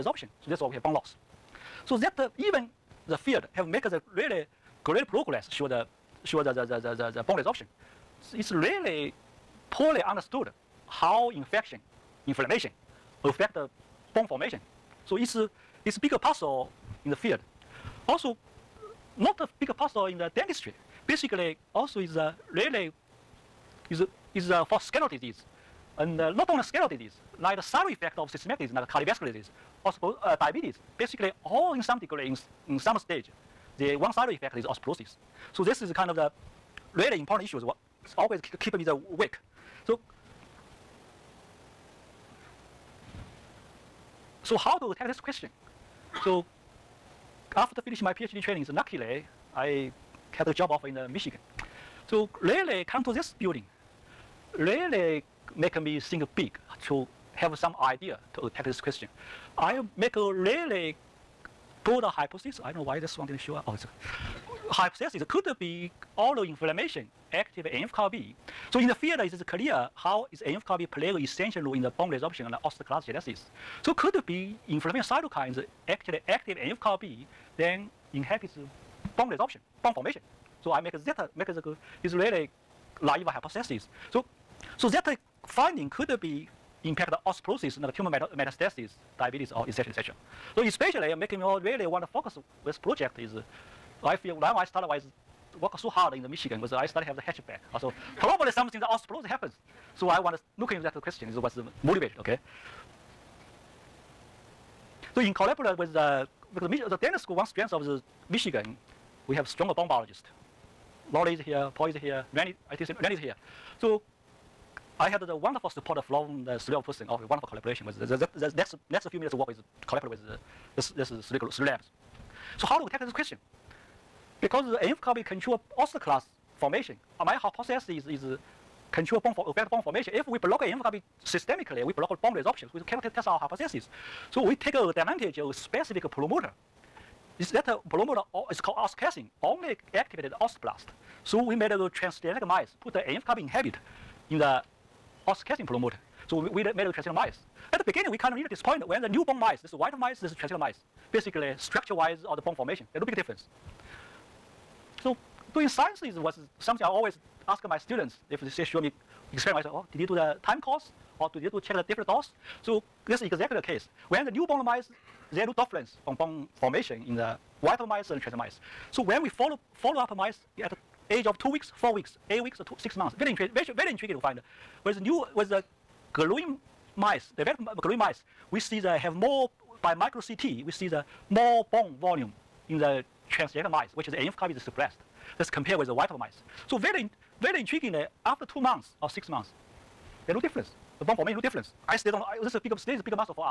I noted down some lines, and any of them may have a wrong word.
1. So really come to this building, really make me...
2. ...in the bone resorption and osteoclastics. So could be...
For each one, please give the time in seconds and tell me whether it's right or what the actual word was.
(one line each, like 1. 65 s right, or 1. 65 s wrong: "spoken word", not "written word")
1. 52 s right
2. 71 s right.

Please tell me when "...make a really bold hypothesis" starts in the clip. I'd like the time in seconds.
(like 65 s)
59 s.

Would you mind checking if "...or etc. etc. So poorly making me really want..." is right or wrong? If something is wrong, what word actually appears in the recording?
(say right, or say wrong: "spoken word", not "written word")
wrong: "especially", not "poorly".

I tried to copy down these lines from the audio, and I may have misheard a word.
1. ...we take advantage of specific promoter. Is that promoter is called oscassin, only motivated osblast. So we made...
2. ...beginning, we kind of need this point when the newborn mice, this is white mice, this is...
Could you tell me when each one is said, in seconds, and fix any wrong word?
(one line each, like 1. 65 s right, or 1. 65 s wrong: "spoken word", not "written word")
1. 134 s wrong: "activated", not "motivated"
2. 147 s right.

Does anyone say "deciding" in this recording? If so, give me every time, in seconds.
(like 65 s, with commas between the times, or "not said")
not said.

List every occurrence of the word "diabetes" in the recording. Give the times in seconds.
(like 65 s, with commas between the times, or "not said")
30 s, 89 s.